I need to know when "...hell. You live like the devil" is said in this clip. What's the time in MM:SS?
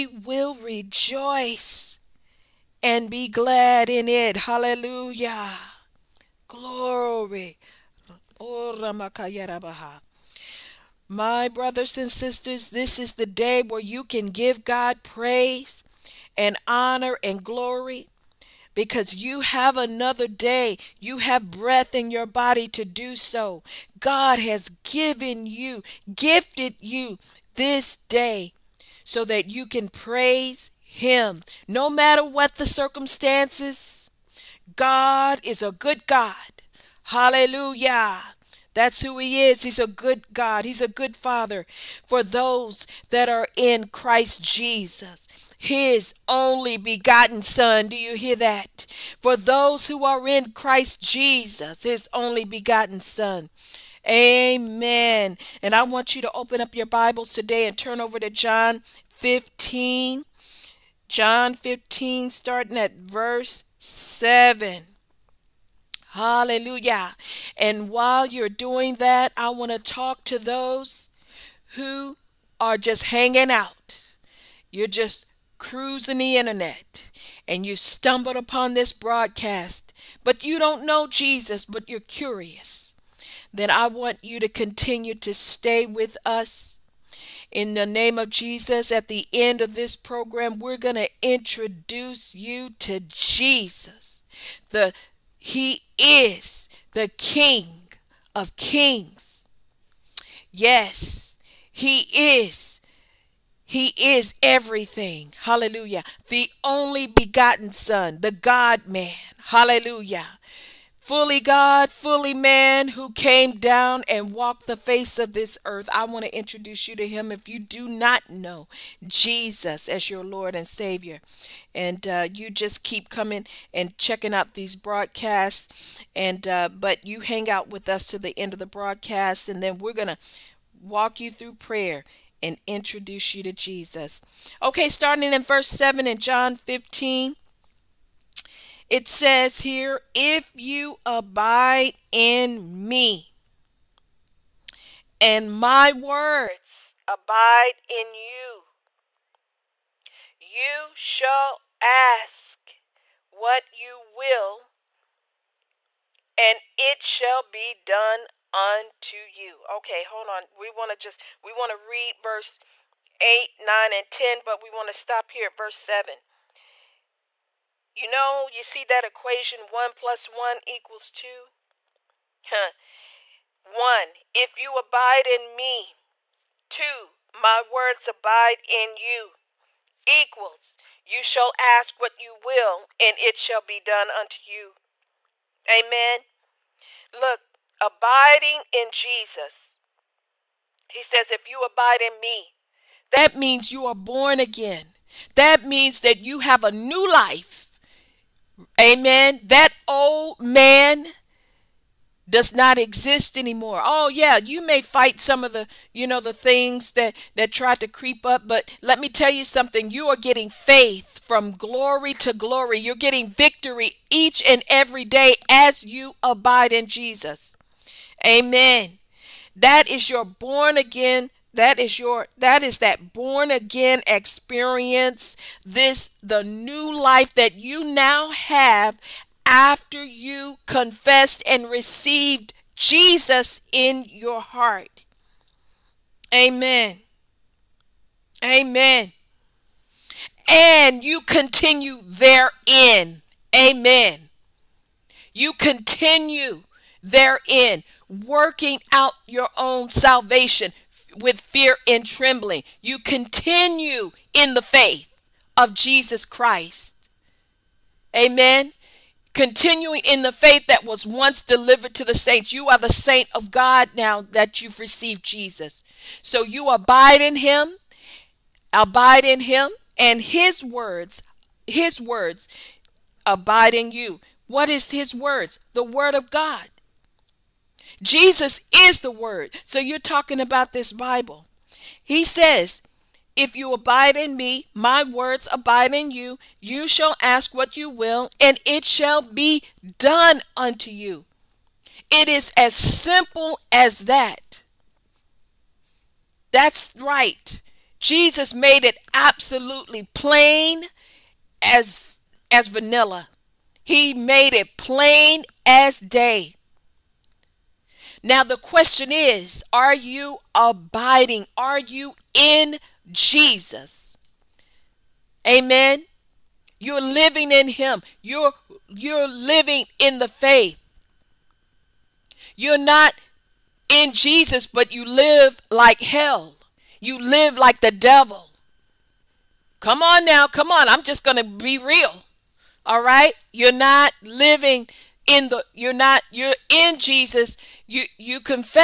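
05:26.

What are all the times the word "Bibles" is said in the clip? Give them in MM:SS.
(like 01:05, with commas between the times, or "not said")
00:56, 04:40.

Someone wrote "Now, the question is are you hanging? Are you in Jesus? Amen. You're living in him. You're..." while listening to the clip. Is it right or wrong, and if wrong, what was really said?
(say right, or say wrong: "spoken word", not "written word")
wrong: "abiding", not "hanging".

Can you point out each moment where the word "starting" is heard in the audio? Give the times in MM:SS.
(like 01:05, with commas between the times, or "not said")
01:02, 02:14.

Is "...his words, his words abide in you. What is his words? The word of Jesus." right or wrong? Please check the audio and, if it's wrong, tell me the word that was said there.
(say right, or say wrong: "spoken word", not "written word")
wrong: "God", not "Jesus".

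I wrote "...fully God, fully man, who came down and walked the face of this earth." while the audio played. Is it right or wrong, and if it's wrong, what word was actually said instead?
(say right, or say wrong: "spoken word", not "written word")
right.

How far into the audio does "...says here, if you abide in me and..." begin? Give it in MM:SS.
02:19.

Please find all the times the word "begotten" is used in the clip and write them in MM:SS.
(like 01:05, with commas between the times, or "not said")
00:46, 00:52, 01:47.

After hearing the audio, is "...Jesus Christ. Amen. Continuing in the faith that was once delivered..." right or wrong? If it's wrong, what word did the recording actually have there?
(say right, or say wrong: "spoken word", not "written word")
right.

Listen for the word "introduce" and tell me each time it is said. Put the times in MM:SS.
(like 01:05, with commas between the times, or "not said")
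01:31, 01:56, 02:12.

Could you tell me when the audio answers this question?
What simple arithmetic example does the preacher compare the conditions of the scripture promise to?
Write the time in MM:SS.
02:49.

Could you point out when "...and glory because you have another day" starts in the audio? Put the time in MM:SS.
00:17.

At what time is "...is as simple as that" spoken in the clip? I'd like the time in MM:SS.
04:52.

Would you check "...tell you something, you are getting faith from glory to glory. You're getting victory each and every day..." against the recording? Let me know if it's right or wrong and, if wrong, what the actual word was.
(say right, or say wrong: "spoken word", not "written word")
right.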